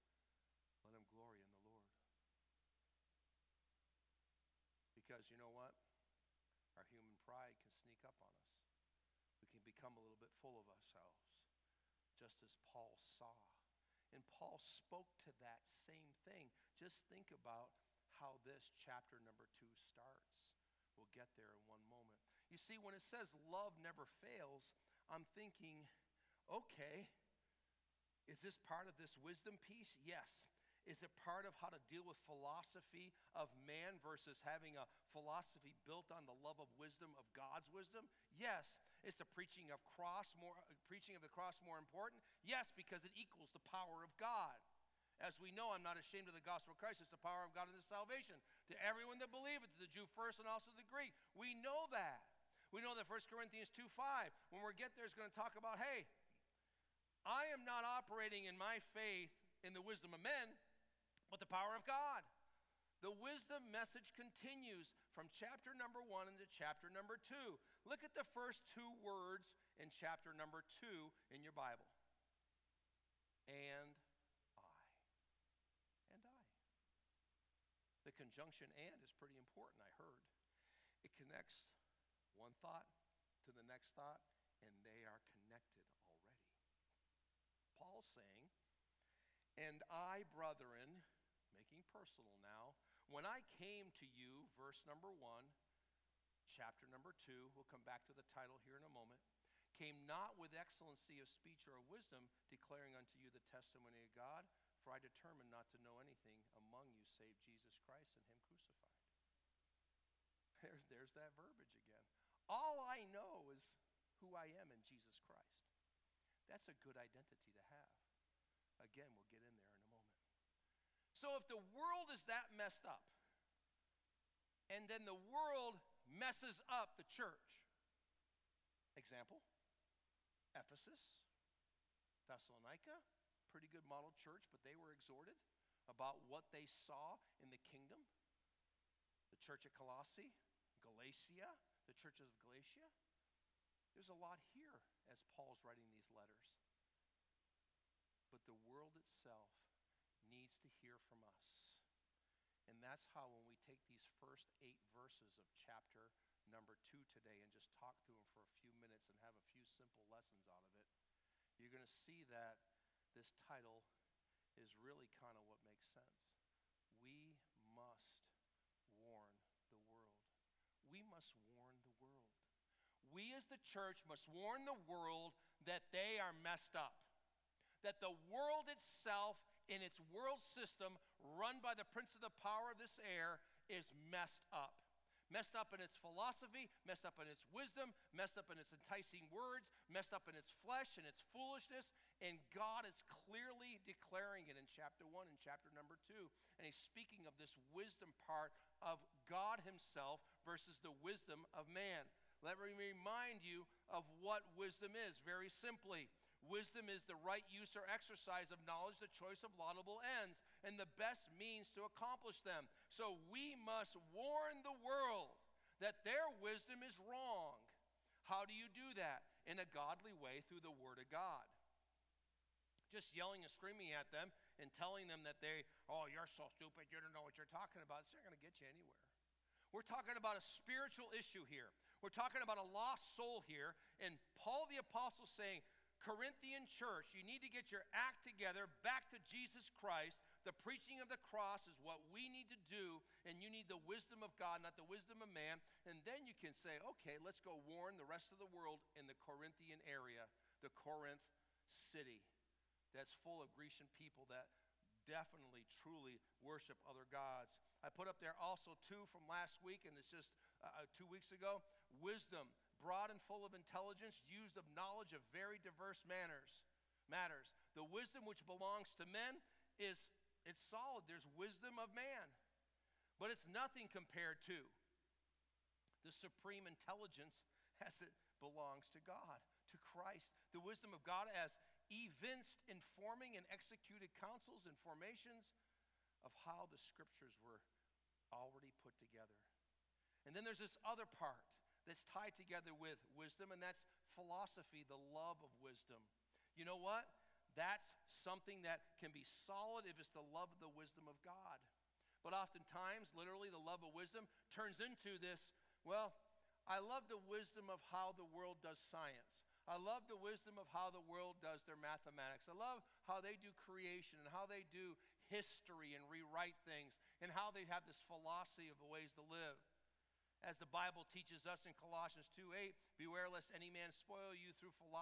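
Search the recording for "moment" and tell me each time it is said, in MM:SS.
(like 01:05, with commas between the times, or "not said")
00:21, 01:38, 01:59.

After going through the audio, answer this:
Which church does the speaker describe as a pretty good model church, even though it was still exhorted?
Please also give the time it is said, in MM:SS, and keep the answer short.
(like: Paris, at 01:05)
Thessalonica, at 02:12.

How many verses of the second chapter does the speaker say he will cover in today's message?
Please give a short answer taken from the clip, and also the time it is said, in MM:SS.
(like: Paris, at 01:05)
8, at 02:34.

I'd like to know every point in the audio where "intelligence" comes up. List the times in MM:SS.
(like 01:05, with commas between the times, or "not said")
04:23, 04:36.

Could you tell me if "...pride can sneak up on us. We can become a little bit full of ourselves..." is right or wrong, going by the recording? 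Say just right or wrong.
right.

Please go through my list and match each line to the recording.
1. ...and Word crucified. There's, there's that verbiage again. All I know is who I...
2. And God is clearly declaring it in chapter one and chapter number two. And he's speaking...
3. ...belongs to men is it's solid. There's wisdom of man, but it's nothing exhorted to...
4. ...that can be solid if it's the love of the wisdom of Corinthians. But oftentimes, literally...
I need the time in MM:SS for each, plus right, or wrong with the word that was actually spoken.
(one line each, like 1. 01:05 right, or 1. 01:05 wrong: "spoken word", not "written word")
1. 01:48 wrong: "Him", not "Word"
2. 03:12 right
3. 04:28 wrong: "compared", not "exhorted"
4. 04:58 wrong: "God", not "Corinthians".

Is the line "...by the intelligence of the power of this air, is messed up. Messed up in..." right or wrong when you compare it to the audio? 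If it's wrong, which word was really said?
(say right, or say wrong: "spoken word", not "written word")
wrong: "prince", not "intelligence".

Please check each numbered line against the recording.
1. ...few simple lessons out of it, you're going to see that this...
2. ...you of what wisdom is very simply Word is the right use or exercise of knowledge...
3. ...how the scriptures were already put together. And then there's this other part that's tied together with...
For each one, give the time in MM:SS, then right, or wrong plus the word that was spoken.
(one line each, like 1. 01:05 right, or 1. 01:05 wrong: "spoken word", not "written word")
1. 02:39 right
2. 03:23 wrong: "Wisdom", not "Word"
3. 04:46 right.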